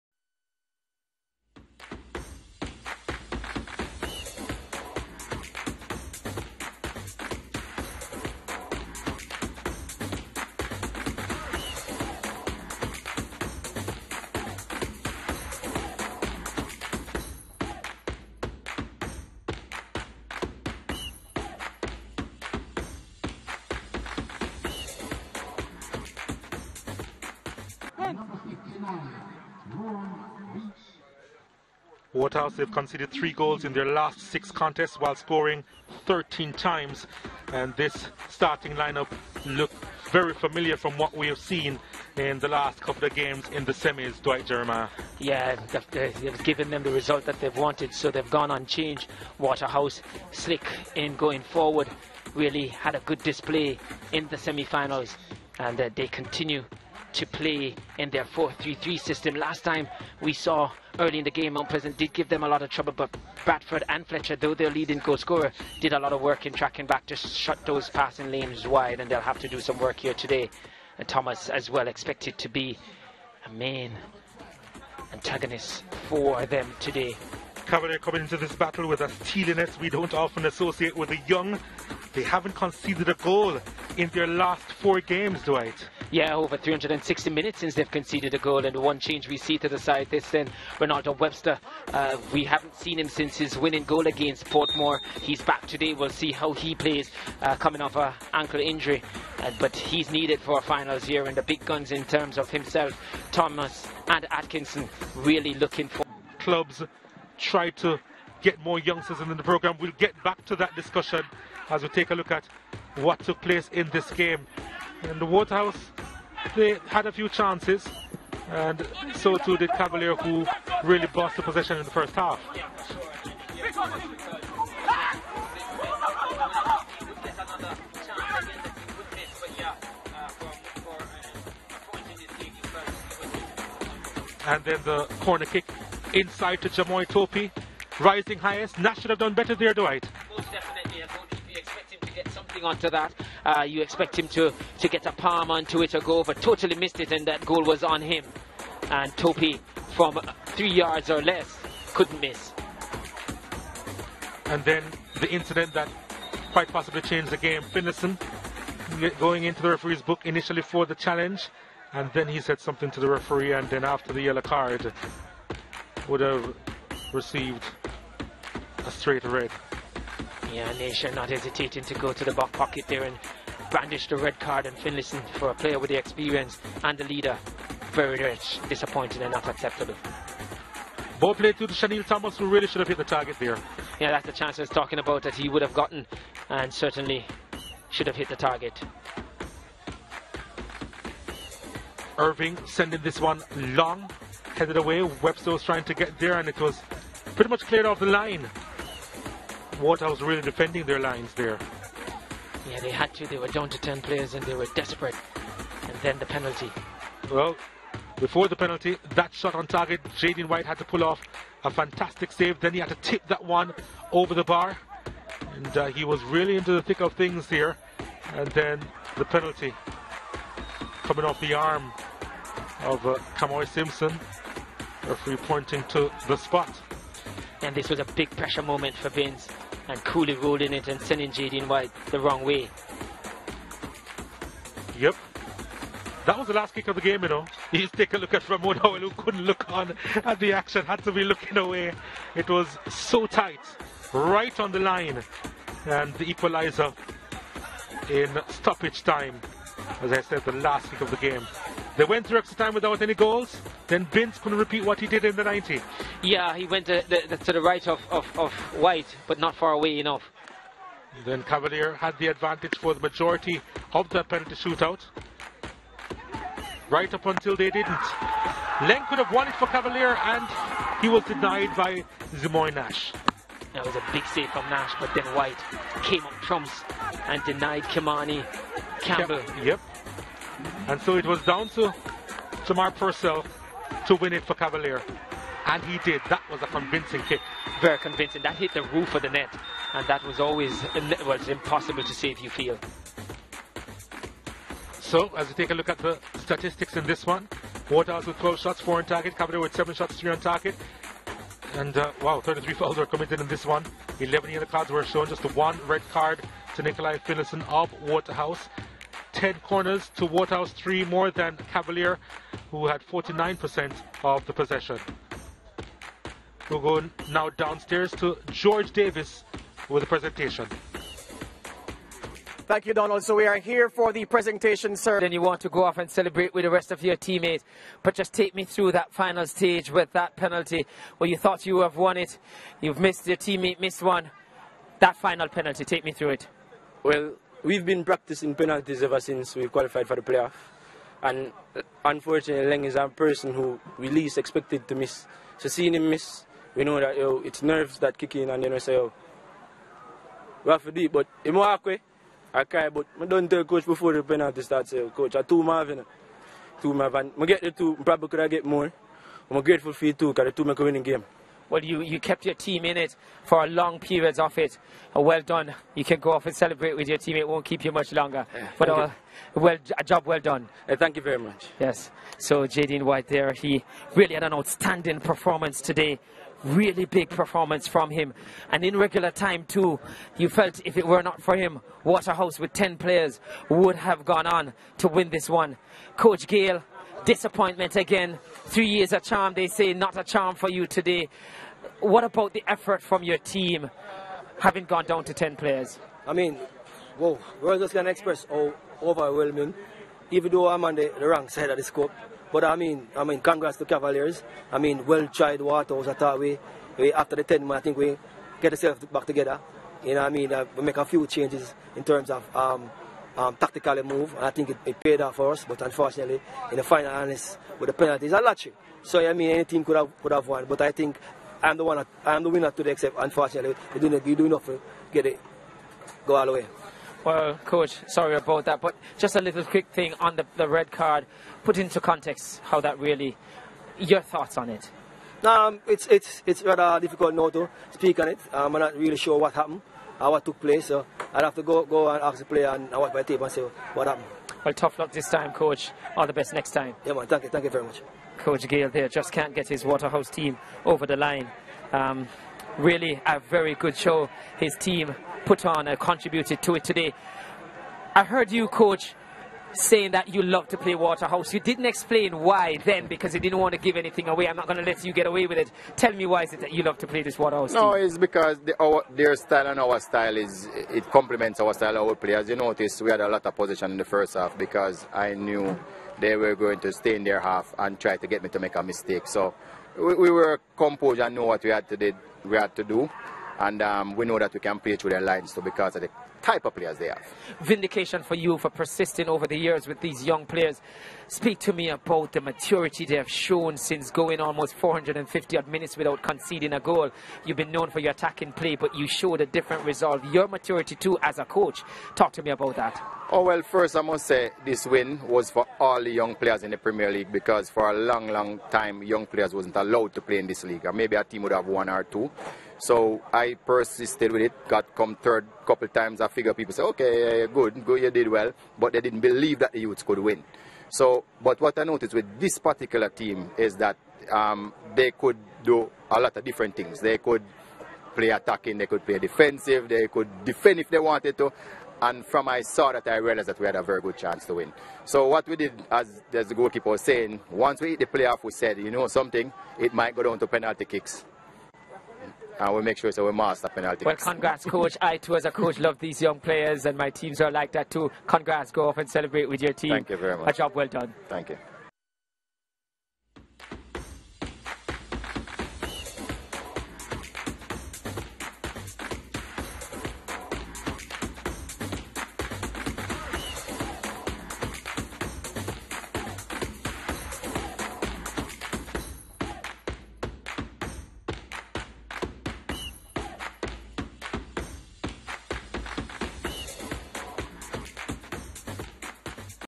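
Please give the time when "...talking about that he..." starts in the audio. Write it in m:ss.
3:04.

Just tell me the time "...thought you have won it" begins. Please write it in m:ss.
5:31.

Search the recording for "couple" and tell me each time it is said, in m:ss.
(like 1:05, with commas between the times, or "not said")
0:42, 8:35.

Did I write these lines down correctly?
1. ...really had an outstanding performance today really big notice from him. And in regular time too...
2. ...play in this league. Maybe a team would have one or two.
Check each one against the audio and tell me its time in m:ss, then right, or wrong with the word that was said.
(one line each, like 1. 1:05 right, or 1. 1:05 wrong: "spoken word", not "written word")
1. 6:14 wrong: "performance", not "notice"
2. 8:30 right.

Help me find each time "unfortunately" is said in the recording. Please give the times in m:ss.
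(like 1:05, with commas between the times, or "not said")
5:42, 6:55, 7:03.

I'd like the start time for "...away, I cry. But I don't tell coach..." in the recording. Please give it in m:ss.
5:51.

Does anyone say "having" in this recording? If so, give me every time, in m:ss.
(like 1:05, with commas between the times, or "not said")
6:34.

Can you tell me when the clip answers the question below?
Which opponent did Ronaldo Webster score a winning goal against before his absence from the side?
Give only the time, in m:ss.
1:34.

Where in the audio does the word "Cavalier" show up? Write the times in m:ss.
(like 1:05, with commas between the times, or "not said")
1:17, 1:59, 4:21, 4:29, 4:44, 4:59, 5:11, 6:43.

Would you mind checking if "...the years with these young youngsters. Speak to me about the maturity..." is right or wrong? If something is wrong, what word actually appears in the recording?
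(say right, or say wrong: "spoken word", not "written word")
wrong: "players", not "youngsters".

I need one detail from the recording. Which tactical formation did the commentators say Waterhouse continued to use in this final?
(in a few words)
4-3-3.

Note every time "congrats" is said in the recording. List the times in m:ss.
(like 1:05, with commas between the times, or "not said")
6:43, 9:04, 9:08.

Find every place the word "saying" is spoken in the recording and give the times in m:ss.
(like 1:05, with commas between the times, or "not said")
7:39, 8:57.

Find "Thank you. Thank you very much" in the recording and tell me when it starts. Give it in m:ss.
7:27.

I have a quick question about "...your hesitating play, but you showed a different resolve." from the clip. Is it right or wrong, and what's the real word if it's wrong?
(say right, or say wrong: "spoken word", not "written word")
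wrong: "attacking", not "hesitating".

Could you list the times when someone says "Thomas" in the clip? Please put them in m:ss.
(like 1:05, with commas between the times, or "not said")
1:11, 1:43, 3:02.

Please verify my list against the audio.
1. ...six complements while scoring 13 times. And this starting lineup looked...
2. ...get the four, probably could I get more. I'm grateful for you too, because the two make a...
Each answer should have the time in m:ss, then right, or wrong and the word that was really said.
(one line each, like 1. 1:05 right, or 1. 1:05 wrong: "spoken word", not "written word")
1. 0:34 wrong: "contests", not "complements"
2. 5:57 wrong: "two", not "four".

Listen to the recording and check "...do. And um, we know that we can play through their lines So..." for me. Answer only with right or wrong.
right.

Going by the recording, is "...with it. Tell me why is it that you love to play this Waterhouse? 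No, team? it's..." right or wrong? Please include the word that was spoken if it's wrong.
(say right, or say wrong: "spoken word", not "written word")
right.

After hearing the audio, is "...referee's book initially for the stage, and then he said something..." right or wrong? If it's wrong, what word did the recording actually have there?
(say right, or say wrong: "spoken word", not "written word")
wrong: "challenge", not "stage".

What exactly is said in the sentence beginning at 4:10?
As I said, the last kick of the game.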